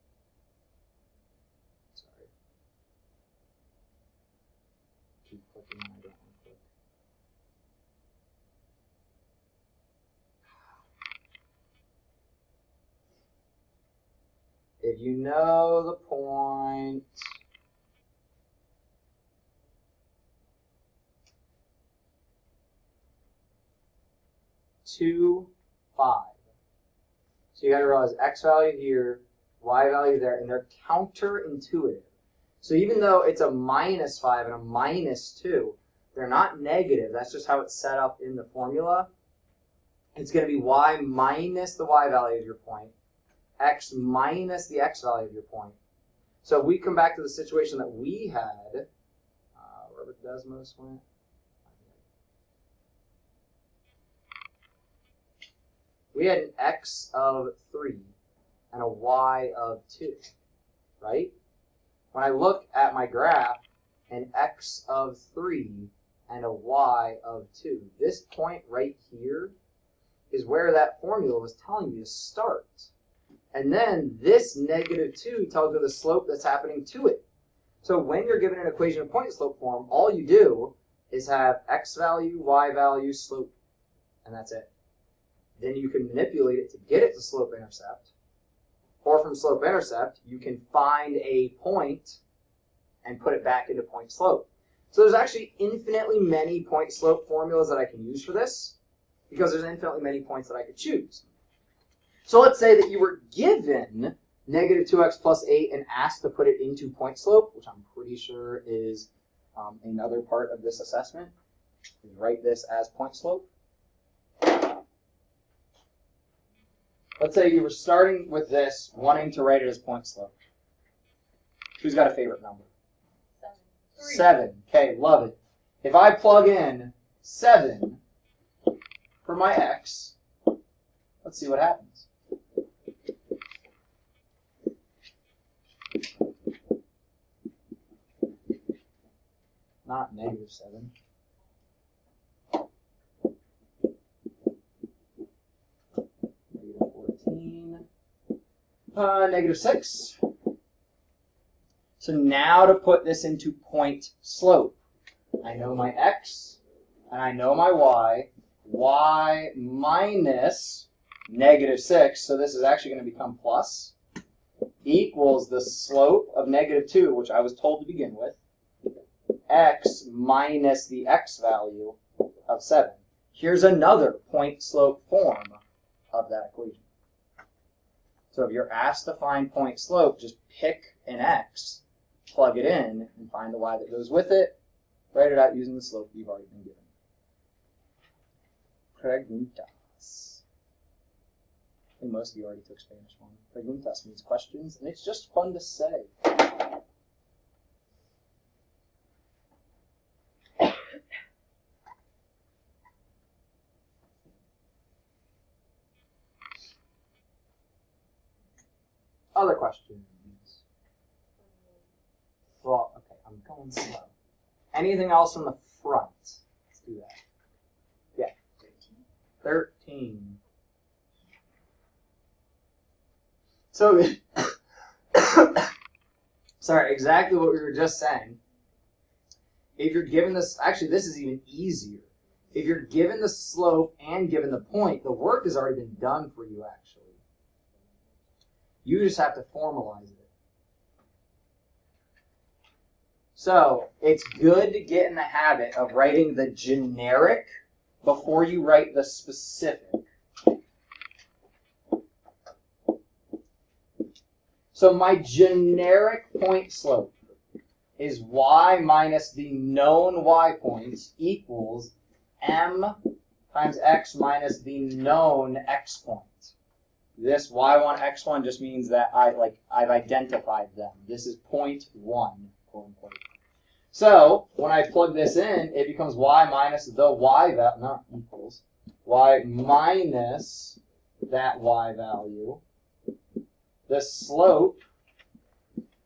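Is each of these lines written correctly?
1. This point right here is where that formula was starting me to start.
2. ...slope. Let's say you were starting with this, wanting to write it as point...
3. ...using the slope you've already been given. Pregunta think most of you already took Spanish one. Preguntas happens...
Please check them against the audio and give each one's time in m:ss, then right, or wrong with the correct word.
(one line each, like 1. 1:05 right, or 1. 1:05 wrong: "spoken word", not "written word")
1. 1:07 wrong: "telling", not "starting"
2. 1:53 right
3. 3:05 wrong: "means", not "happens".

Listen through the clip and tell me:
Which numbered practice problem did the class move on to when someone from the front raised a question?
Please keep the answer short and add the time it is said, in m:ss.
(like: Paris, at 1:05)
13, at 3:39.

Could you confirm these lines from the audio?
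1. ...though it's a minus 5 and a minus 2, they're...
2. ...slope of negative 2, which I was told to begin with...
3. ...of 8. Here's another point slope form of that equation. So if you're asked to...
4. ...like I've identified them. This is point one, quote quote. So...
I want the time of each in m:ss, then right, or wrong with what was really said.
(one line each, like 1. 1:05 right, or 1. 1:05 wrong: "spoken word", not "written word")
1. 0:33 right
2. 2:45 right
3. 2:52 wrong: "7", not "8"
4. 4:29 wrong: "unquote", not "quote".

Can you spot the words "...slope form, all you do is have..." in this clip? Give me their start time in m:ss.
1:19.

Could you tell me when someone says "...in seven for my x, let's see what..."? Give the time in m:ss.
2:06.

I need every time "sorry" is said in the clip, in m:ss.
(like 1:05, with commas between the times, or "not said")
3:46.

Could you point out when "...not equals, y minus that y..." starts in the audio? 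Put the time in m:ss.
4:37.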